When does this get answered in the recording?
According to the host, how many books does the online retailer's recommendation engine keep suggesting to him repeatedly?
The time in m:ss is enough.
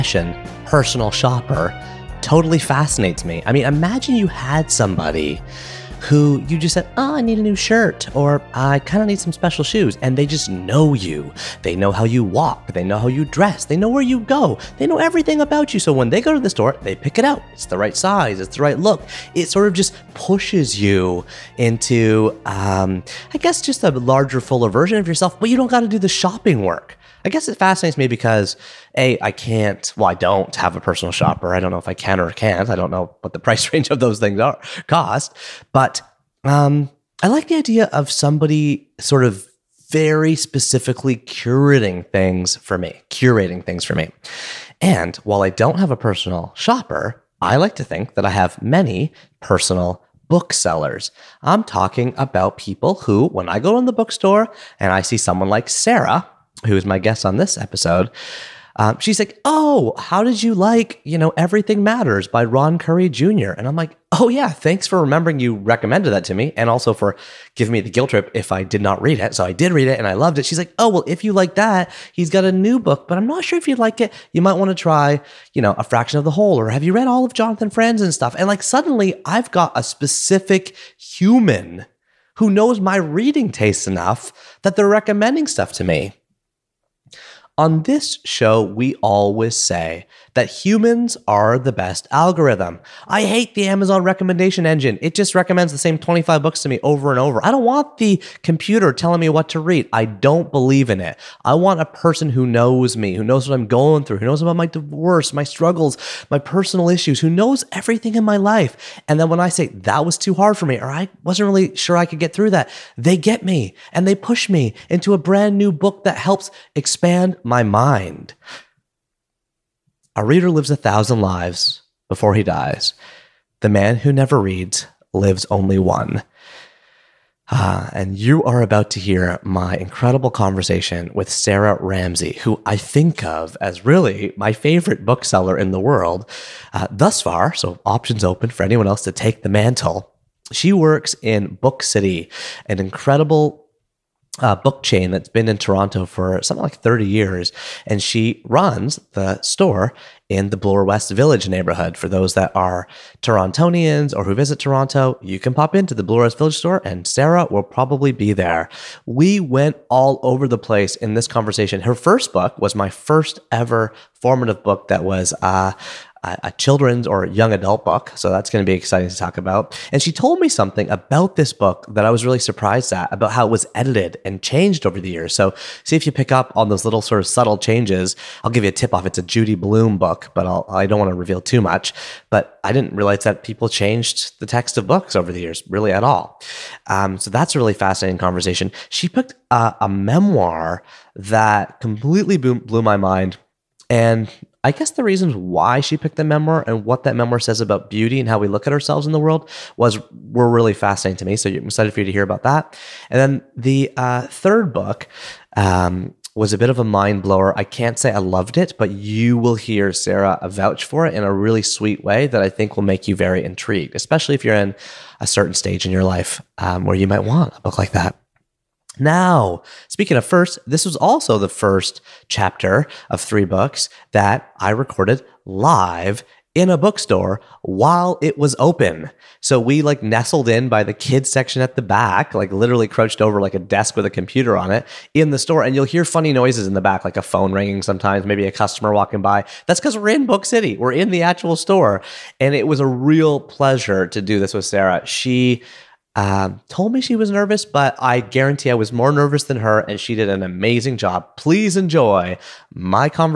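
1:35.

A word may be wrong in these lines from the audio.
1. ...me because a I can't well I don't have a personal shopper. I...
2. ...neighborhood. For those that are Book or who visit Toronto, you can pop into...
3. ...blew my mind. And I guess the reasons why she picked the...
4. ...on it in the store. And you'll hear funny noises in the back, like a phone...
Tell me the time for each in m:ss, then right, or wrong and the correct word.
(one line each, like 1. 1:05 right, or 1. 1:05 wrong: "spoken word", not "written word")
1. 0:27 right
2. 2:31 wrong: "Torontonians", not "Book"
3. 3:12 right
4. 3:54 right.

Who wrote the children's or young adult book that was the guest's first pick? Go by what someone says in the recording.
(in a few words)
Judy Blume.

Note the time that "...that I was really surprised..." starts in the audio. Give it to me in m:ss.
2:51.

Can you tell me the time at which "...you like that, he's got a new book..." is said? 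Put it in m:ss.
1:11.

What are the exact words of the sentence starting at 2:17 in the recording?
So, options open for anyone else to take the mantle.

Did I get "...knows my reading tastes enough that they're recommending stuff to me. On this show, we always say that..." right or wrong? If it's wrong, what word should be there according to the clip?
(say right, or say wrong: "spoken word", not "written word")
right.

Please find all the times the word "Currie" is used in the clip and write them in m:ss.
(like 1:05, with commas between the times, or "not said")
1:02.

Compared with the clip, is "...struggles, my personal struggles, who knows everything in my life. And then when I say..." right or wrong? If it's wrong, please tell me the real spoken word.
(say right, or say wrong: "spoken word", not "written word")
wrong: "issues", not "struggles".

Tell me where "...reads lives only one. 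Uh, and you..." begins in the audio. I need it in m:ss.
2:04.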